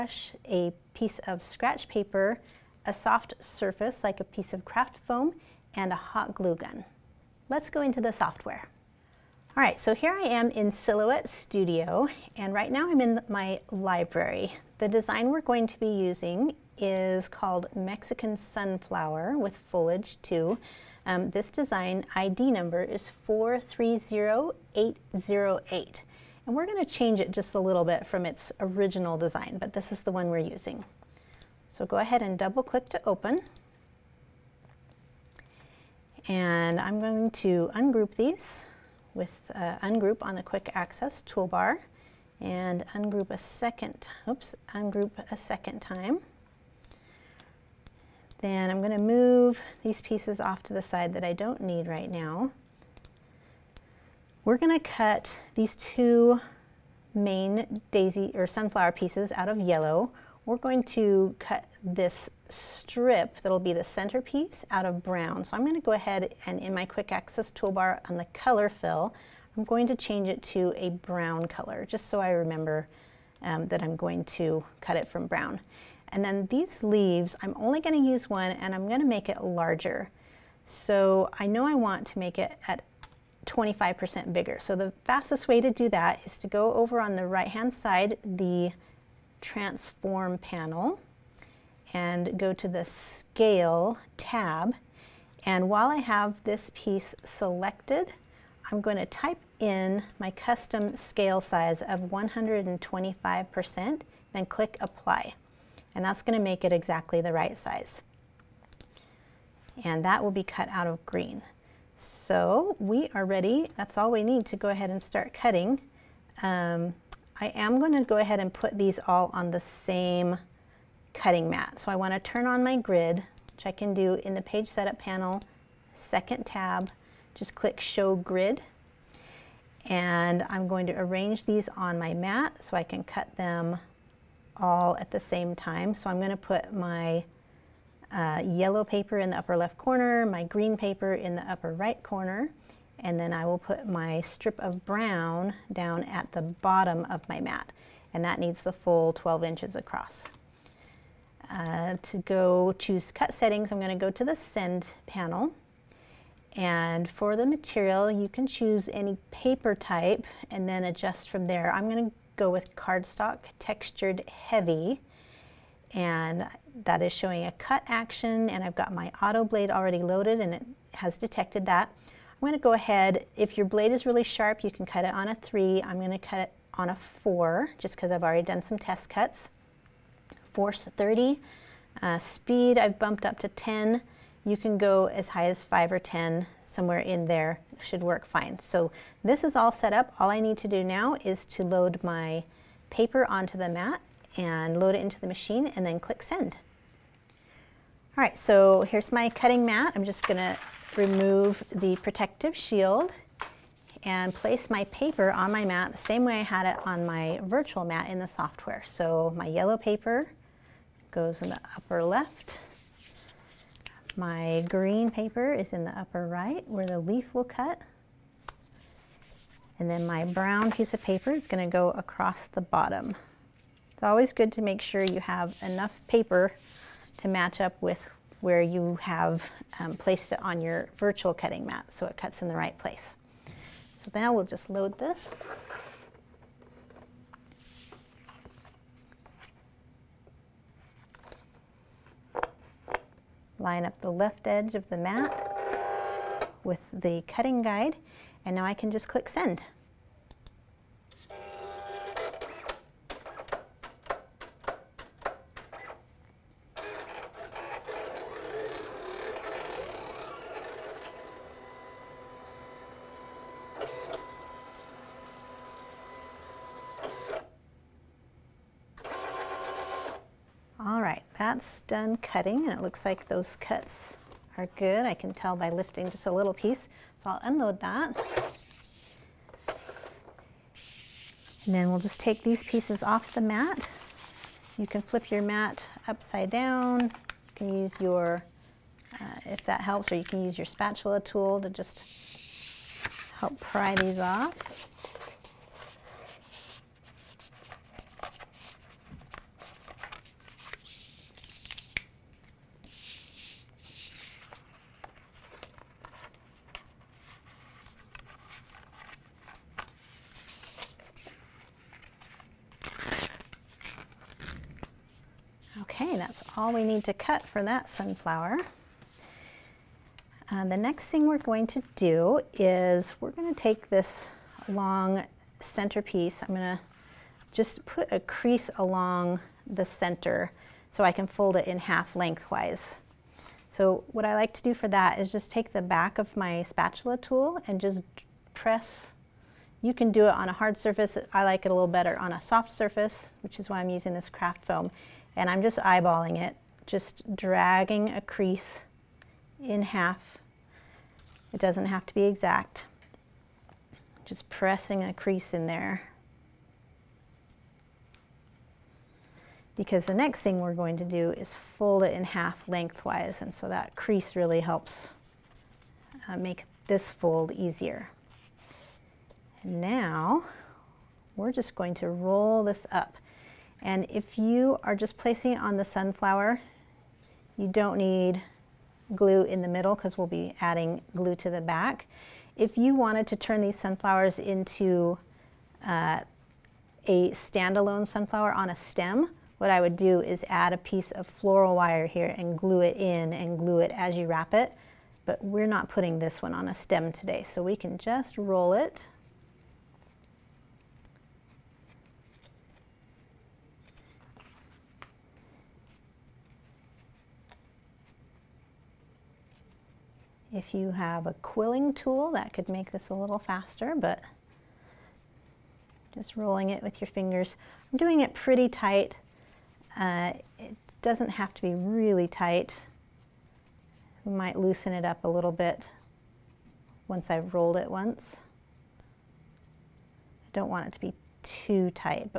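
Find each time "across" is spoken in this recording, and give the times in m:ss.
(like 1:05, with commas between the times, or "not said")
2:29, 3:41.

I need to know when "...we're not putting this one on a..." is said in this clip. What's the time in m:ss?
6:35.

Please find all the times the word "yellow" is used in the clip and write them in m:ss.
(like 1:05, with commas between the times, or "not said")
0:59, 2:18, 3:29.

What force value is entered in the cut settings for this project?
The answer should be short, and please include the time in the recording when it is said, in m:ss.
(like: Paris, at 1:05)
30, at 3:00.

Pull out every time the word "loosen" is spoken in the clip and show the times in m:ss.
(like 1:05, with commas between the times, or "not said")
7:04.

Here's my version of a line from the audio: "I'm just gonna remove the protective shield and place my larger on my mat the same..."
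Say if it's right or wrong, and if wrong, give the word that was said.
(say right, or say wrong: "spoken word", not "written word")
wrong: "paper", not "larger".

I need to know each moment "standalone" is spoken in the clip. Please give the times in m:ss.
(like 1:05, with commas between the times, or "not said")
6:27.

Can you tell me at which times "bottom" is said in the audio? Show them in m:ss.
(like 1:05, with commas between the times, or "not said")
2:26, 3:42.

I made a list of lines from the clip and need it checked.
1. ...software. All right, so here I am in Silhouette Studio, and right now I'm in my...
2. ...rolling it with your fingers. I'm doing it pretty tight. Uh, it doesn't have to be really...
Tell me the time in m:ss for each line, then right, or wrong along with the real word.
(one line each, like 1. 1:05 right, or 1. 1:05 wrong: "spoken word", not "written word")
1. 0:08 right
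2. 6:56 right.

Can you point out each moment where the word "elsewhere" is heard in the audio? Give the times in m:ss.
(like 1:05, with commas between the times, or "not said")
not said.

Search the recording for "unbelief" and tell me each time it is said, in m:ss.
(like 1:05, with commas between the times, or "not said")
not said.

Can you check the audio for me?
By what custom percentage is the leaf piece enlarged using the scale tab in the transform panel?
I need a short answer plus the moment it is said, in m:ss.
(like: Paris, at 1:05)
125%, at 1:42.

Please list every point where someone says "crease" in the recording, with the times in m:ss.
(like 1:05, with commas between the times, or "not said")
5:28, 5:48, 5:55, 6:03.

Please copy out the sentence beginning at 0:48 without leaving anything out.
Then I'm going to move these pieces off to the side that I don't need right now.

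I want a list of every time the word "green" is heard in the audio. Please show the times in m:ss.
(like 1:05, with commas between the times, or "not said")
1:51, 2:20, 3:34.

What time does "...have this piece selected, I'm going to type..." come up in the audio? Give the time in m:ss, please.
1:35.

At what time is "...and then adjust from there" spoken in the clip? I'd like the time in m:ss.
2:40.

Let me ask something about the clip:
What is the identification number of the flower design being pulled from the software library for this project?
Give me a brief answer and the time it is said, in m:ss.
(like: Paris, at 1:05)
430808, at 0:23.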